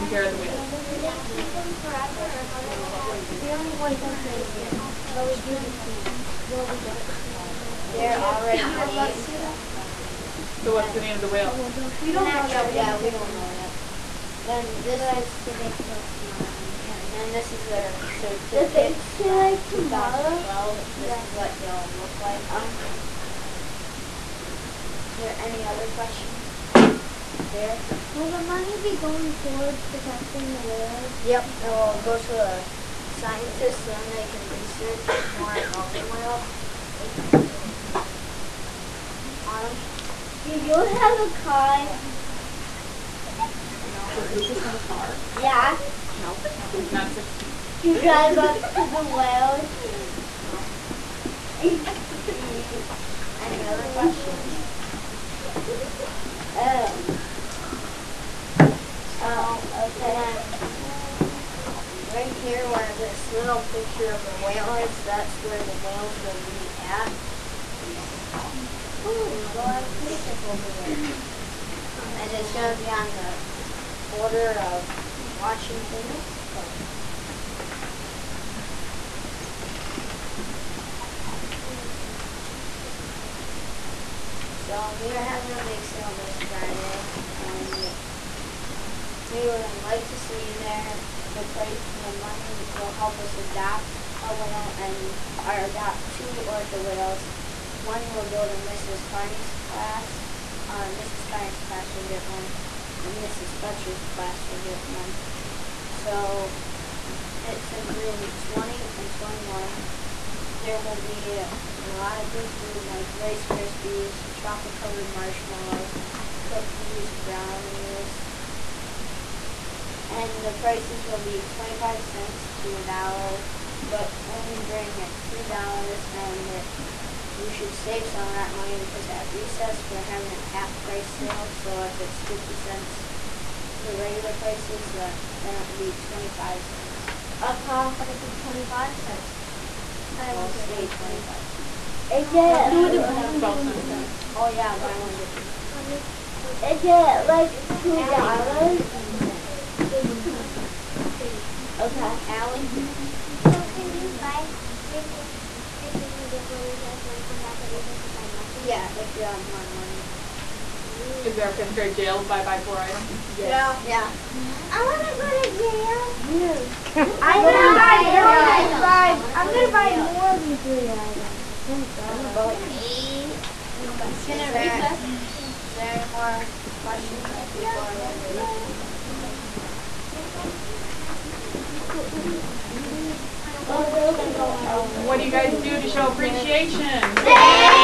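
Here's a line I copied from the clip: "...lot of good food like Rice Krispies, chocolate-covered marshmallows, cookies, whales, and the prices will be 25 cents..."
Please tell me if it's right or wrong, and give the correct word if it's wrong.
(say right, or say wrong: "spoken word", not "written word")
wrong: "brownies", not "whales".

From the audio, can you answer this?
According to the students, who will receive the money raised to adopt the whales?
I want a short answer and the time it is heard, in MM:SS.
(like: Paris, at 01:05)
The scientists, at 00:32.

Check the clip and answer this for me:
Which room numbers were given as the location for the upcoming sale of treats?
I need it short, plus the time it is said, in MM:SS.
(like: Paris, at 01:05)
Rooms 20 and 21, at 01:47.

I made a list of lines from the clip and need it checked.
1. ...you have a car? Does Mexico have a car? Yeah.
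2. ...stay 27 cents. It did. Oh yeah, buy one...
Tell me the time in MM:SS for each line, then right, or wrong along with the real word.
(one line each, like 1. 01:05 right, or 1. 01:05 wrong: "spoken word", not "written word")
1. 00:40 wrong: "Lucas", not "Mexico"
2. 02:20 wrong: "25", not "27".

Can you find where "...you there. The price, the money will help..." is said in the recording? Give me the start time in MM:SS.
01:30.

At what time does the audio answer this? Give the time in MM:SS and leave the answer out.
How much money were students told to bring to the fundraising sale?
02:05.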